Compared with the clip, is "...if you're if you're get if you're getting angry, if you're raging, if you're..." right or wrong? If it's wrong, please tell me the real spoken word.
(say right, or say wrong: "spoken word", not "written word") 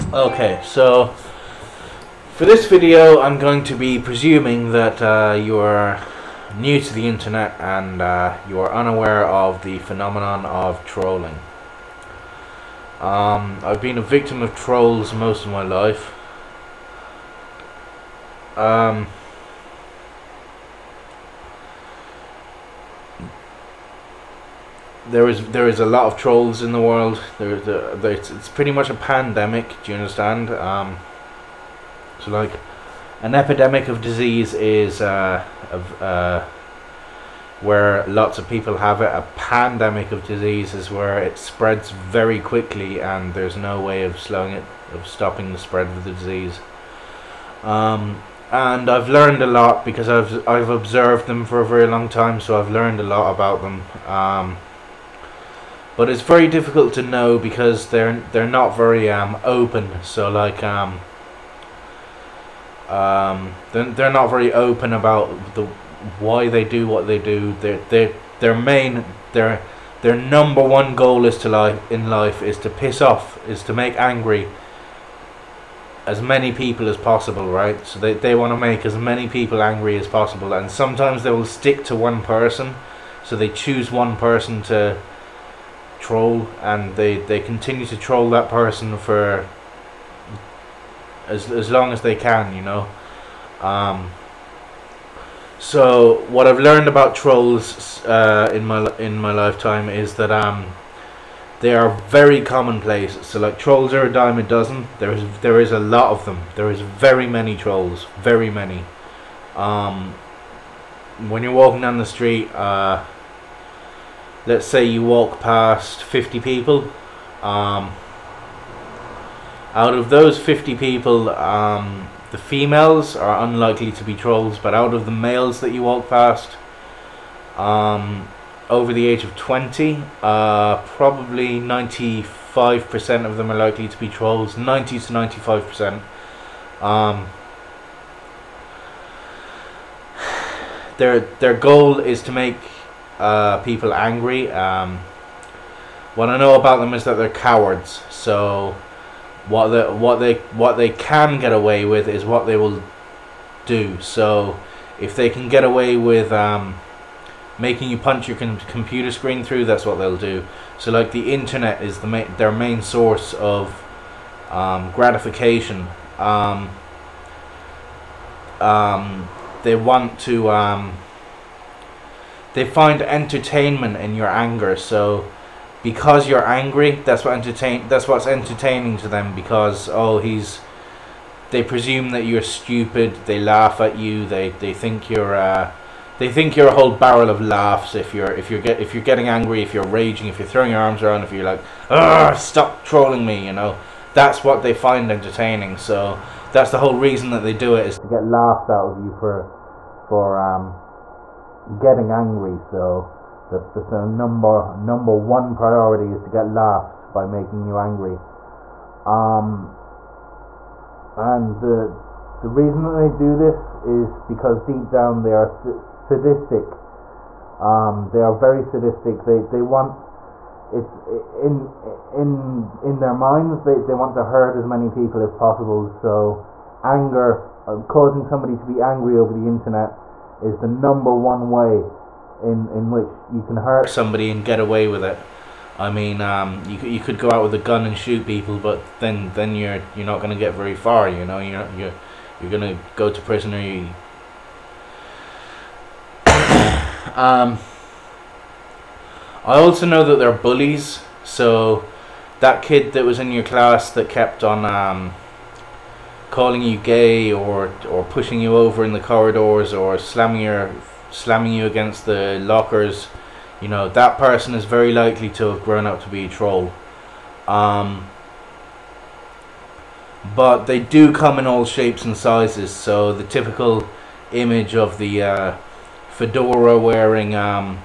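right.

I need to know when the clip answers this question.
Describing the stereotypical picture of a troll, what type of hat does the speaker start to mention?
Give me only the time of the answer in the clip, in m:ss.
4:36.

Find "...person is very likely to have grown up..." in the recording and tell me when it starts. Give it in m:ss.
4:24.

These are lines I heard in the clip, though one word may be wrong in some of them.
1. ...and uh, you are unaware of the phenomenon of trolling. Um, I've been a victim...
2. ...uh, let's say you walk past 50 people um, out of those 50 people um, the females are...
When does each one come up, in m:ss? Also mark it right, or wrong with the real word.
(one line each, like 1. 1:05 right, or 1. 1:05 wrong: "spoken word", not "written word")
1. 0:07 right
2. 1:52 right.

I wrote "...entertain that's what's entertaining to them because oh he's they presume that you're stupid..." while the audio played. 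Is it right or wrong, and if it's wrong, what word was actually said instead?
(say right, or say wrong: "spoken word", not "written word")
right.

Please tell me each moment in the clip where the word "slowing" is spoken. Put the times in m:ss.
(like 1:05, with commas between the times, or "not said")
0:44.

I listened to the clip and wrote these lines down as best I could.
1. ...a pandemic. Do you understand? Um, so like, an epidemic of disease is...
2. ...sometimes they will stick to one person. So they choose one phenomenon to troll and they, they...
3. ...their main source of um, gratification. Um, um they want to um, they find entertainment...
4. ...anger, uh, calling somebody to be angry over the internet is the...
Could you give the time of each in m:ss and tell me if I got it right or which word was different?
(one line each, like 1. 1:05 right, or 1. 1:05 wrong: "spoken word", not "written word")
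1. 0:28 right
2. 1:20 wrong: "person", not "phenomenon"
3. 2:42 right
4. 3:46 wrong: "causing", not "calling".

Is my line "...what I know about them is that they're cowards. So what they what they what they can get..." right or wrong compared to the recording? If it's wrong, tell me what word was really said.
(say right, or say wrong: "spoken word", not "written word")
right.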